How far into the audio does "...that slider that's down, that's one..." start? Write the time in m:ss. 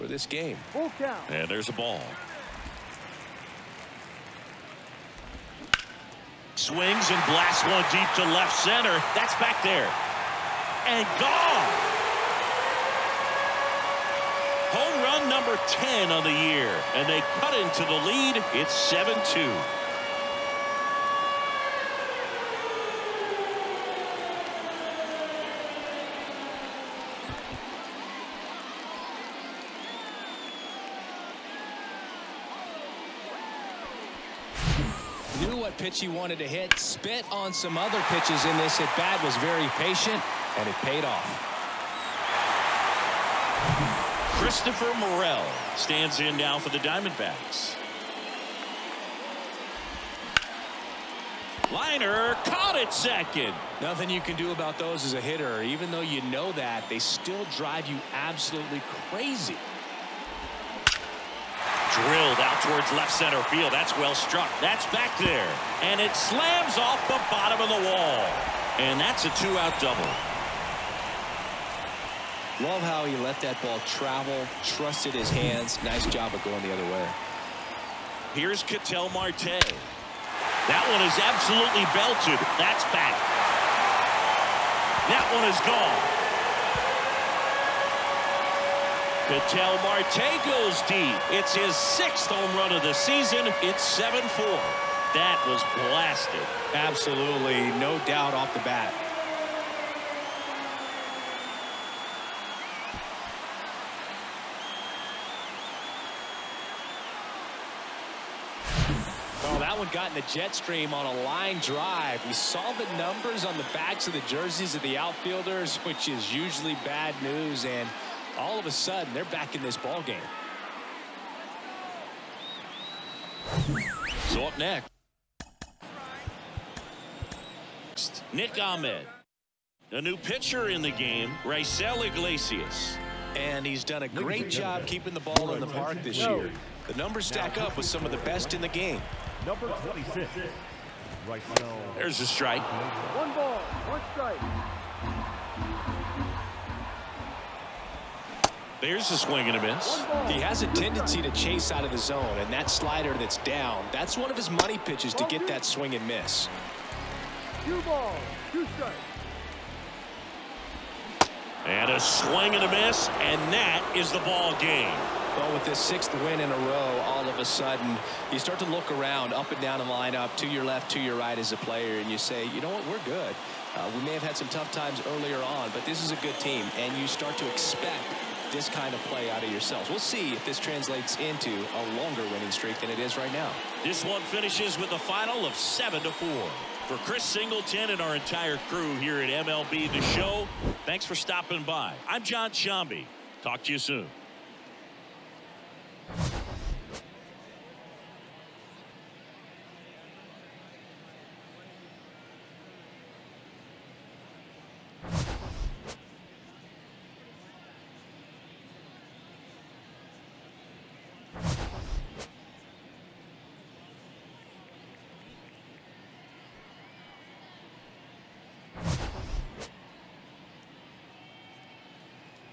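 2:32.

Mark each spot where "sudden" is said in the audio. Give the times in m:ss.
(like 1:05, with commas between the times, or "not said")
1:58, 2:47.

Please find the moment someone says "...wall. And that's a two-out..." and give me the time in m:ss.
1:07.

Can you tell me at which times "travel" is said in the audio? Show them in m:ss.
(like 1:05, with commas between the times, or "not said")
1:13.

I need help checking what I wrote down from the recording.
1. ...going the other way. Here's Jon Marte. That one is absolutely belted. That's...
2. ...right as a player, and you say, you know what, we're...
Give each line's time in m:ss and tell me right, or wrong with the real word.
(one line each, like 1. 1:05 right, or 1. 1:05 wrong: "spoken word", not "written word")
1. 1:16 wrong: "Ketel", not "Jon"
2. 2:51 right.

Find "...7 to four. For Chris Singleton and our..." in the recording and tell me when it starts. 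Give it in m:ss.
3:05.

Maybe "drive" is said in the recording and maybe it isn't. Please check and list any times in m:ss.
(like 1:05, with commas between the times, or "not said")
0:57, 1:51.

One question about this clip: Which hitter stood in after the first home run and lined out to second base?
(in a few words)
Christopher Morel.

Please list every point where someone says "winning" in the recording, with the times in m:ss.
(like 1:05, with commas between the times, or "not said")
3:02.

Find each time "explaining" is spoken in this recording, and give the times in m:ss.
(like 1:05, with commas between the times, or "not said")
not said.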